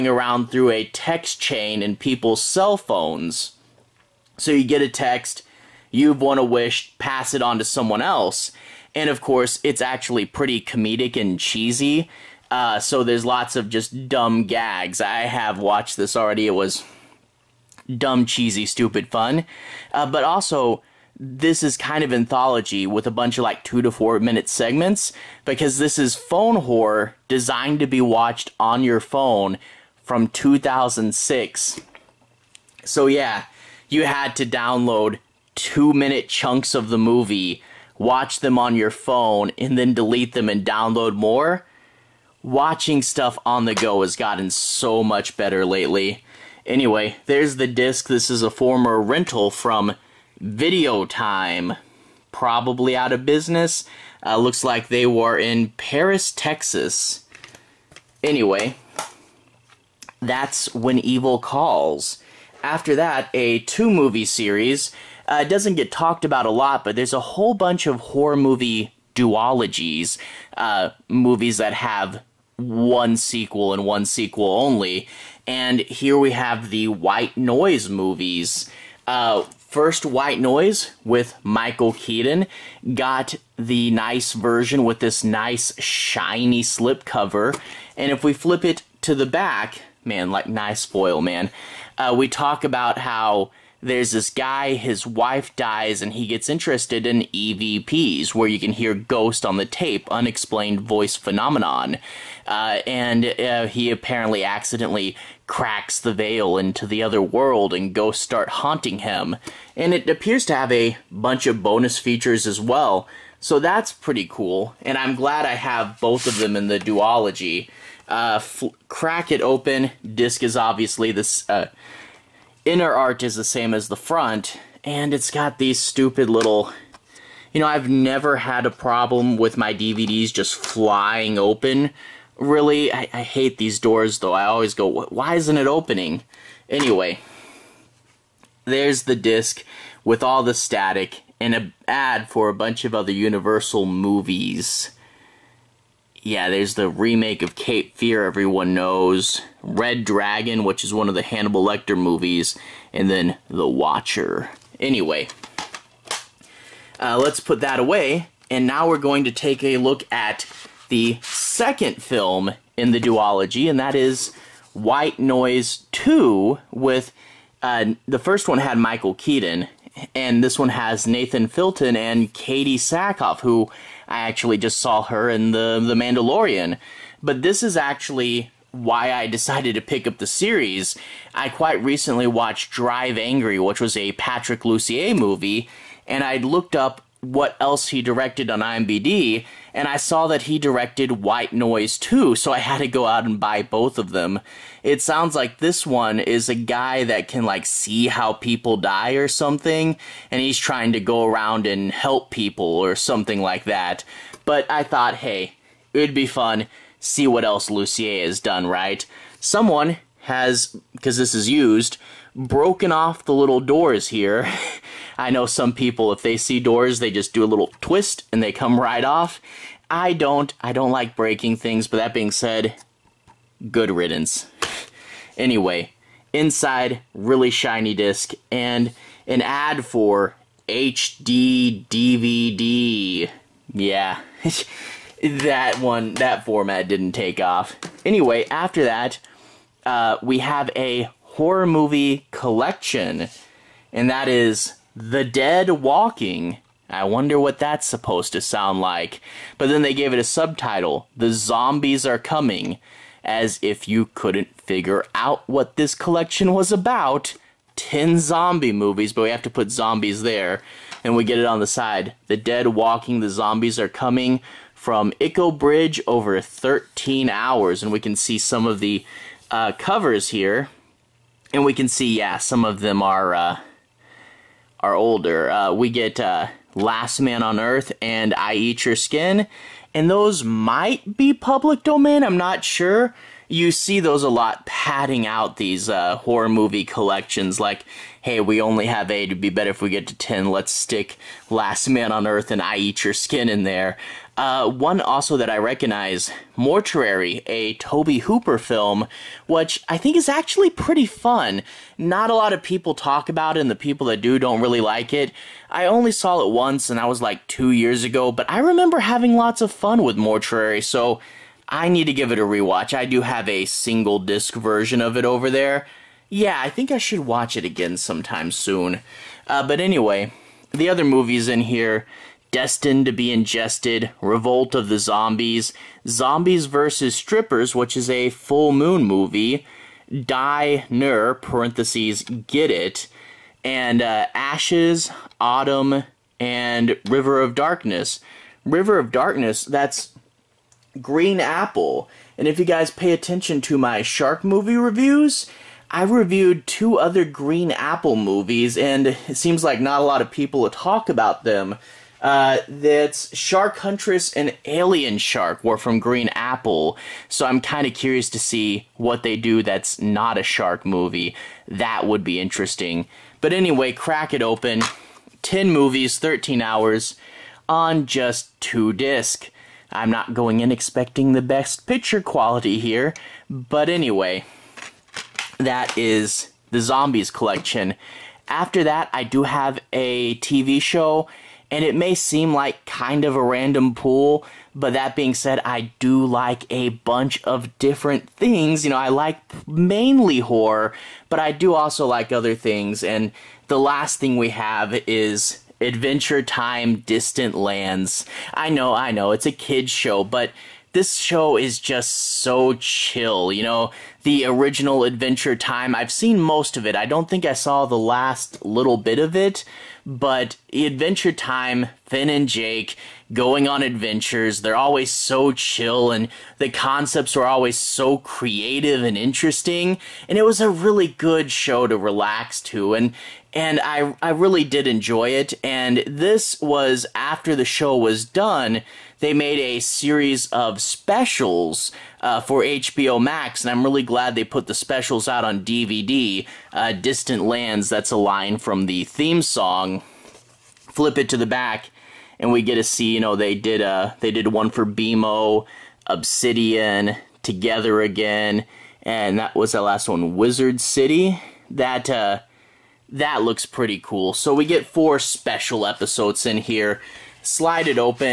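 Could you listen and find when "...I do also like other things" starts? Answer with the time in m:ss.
6:31.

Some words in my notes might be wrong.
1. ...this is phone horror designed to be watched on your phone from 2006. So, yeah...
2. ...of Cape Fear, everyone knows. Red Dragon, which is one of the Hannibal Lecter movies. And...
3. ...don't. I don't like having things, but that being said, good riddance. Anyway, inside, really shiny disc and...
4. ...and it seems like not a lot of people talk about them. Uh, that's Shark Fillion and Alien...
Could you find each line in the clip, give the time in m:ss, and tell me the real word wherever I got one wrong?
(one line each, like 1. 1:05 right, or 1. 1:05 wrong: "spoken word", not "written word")
1. 0:25 right
2. 2:27 right
3. 3:40 wrong: "breaking", not "having"
4. 5:48 wrong: "Huntress", not "Fillion".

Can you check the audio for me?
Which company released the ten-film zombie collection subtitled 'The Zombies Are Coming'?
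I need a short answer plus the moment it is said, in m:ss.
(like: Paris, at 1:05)
Echo Bridge, at 4:25.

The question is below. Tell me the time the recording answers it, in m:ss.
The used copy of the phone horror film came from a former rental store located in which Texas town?
0:55.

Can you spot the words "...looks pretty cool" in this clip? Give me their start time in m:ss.
7:33.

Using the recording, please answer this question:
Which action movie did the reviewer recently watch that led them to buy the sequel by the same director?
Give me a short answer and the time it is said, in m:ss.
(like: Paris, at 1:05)
Drive Angry, at 3:02.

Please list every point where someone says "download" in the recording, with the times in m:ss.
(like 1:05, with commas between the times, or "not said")
0:34, 0:40.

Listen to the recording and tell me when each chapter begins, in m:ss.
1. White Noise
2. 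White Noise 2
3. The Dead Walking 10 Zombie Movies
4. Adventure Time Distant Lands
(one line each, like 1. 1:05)
1. 1:01
2. 2:37
3. 3:57
4. 6:17.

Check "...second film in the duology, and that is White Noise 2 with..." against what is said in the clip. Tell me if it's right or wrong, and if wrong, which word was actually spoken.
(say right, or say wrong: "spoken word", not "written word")
right.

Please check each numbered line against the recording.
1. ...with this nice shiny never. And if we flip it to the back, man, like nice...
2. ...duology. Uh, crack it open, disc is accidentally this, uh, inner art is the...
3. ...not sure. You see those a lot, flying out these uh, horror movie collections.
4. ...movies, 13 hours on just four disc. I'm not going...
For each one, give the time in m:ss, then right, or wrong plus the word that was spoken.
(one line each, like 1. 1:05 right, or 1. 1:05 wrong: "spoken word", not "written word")
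1. 1:24 wrong: "slipcover", not "never"
2. 1:56 wrong: "obviously", not "accidentally"
3. 4:42 wrong: "padding", not "flying"
4. 6:05 wrong: "two", not "four".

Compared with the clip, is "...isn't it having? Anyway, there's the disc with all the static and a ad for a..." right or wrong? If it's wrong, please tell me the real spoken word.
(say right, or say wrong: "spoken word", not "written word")
wrong: "opening", not "having".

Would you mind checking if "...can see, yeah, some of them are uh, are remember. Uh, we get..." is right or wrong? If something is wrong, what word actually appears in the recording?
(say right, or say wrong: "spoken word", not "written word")
wrong: "older", not "remember".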